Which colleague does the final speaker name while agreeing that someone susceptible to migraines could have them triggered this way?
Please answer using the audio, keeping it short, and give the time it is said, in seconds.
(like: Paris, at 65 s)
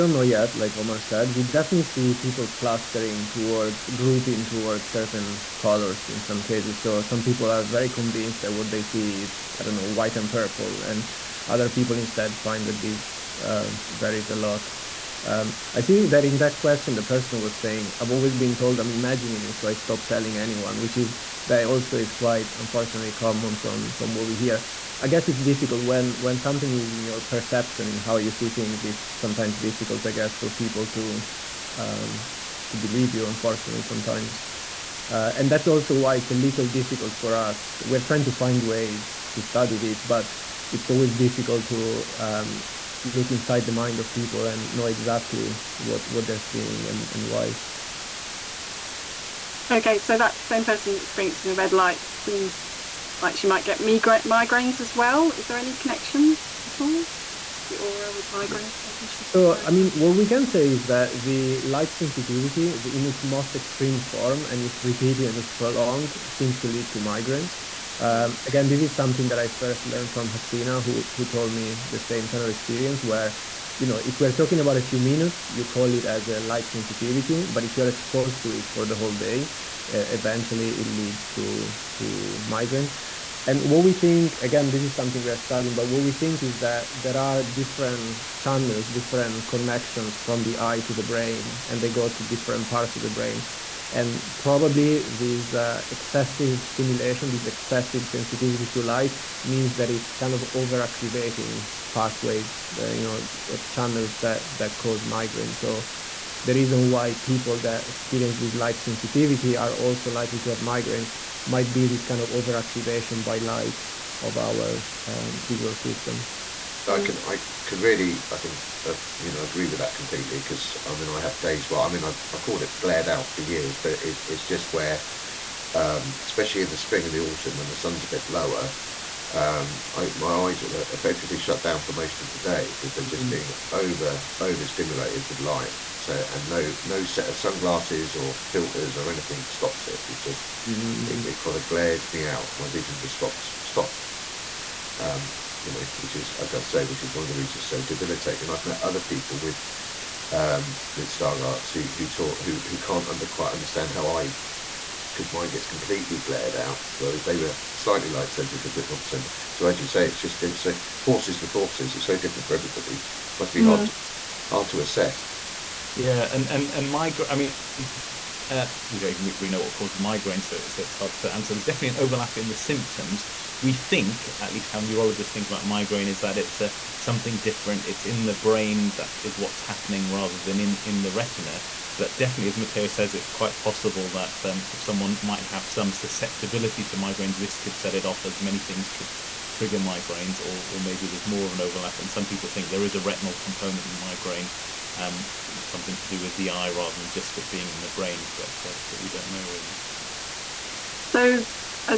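Matteo, at 182 s.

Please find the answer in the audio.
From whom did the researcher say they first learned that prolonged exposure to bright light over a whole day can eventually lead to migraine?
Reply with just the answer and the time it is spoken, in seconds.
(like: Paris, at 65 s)
Hasina, at 70 s.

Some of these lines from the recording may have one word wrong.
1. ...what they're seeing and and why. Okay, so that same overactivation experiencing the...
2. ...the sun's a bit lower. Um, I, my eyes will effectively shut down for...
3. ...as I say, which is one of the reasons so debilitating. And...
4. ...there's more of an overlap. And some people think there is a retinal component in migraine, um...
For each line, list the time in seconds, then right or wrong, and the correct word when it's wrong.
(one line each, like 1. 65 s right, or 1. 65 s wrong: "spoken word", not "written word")
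1. 46 s wrong: "person", not "overactivation"
2. 127 s right
3. 146 s right
4. 191 s right.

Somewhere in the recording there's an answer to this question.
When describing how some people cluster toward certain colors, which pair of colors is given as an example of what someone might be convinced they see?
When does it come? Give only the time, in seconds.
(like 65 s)
9 s.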